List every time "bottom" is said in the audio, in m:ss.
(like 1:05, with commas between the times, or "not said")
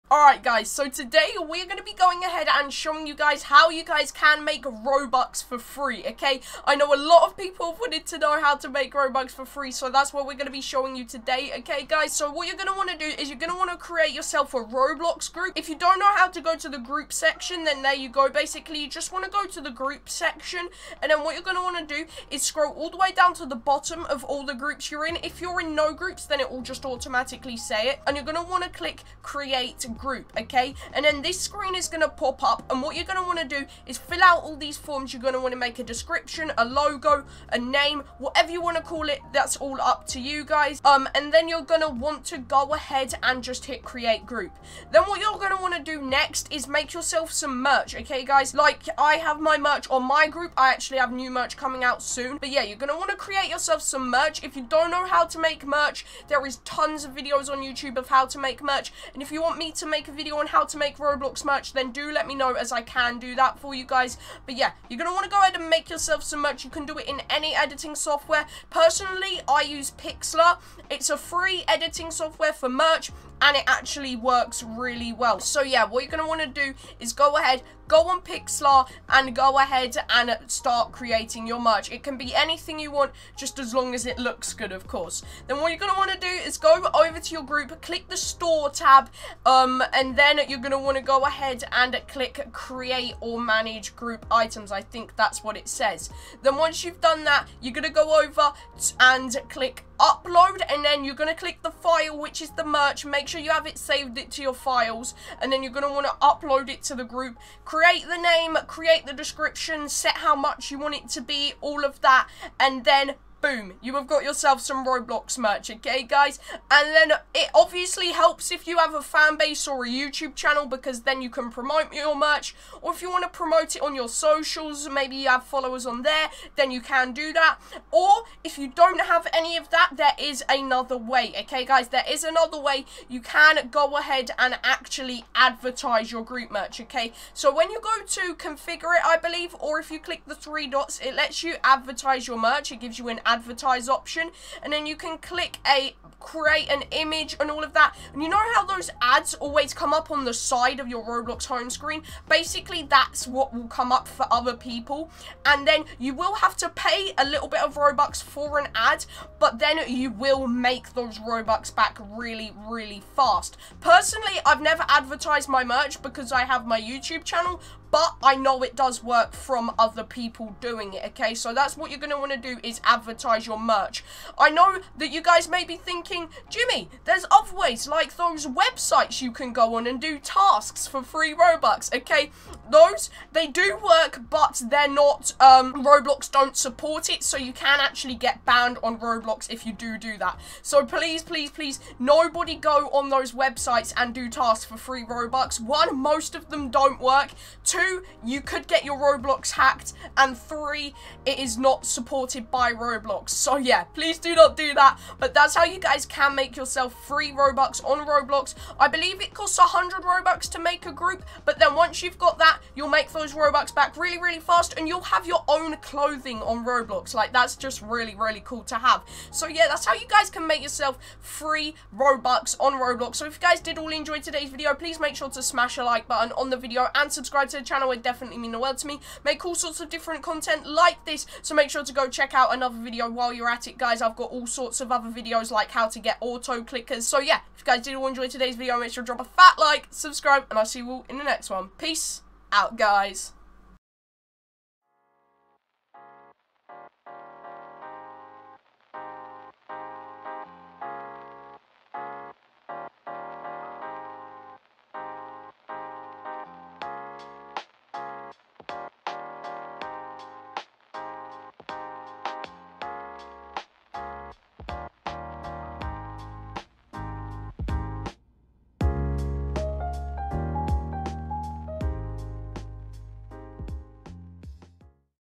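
0:23.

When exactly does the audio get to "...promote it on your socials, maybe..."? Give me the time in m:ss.
2:03.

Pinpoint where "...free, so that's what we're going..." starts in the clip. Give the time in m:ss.
0:09.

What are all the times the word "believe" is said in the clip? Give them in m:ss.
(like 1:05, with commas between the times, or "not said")
2:19, 3:28.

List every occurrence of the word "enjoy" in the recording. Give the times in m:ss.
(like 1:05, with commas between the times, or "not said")
3:43, 3:58.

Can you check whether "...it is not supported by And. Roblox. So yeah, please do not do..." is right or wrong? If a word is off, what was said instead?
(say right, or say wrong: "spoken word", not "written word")
wrong: "Roblox", not "And".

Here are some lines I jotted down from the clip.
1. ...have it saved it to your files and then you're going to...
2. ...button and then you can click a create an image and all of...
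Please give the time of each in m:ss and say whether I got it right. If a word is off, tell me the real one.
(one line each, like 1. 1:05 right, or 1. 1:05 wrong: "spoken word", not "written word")
1. 1:43 right
2. 2:23 wrong: "option", not "button".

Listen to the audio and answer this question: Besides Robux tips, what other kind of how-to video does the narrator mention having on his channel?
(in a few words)
how to get auto clickers.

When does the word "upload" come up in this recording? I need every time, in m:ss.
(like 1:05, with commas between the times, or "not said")
1:39, 1:46.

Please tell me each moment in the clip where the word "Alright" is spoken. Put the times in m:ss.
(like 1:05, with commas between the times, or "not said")
0:00.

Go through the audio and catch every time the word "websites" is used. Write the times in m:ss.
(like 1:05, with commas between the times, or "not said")
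2:58, 3:13.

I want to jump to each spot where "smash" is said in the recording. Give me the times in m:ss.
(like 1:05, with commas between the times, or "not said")
3:45.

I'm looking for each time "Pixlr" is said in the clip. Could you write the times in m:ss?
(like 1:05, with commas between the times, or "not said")
1:09, 1:18.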